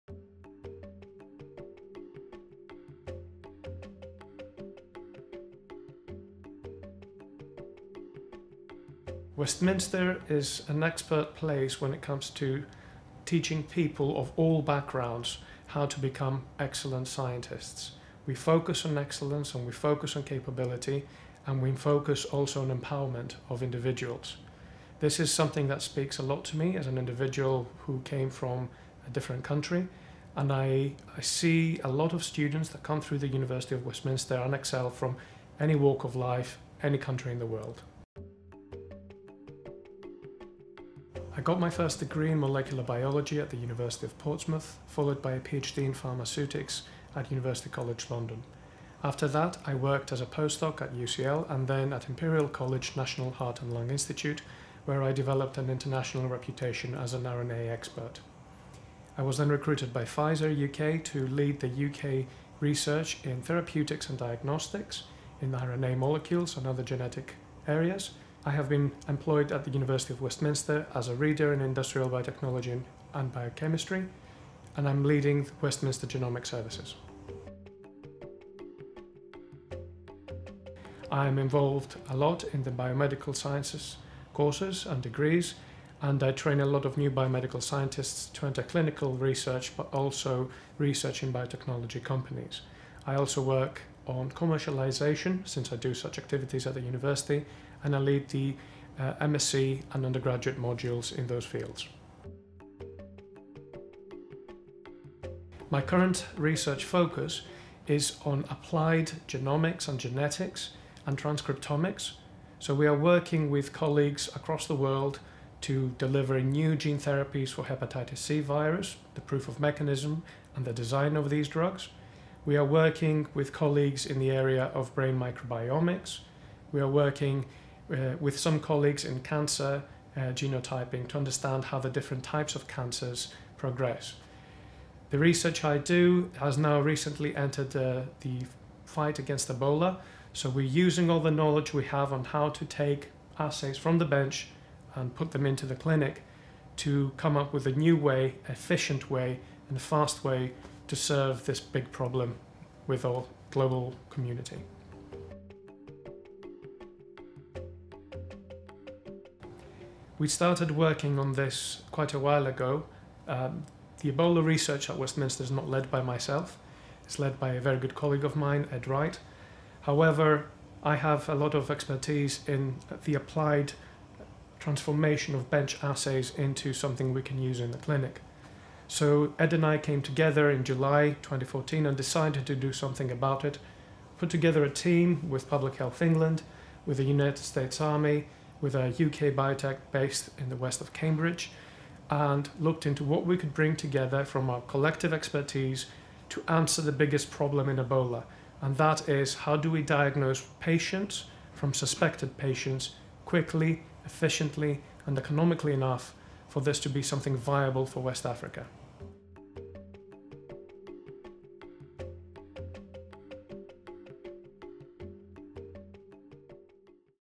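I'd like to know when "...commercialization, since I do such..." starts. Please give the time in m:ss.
1:34.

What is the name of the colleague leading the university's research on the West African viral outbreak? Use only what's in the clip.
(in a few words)
Ed Wright.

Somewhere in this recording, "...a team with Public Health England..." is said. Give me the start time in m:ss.
3:04.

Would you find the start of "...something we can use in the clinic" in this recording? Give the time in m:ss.
2:56.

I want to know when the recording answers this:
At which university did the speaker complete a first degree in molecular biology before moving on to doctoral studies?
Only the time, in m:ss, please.
0:43.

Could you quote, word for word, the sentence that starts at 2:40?
We started working on this quite a while ago.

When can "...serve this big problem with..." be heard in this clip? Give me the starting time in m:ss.
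2:30.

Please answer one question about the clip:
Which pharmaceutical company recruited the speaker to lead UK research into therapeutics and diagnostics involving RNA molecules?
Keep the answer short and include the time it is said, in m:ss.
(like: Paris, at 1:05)
Pfizer, at 1:00.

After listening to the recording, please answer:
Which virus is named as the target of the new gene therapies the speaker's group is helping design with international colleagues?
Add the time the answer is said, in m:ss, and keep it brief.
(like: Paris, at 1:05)
Hepatitis C, at 1:57.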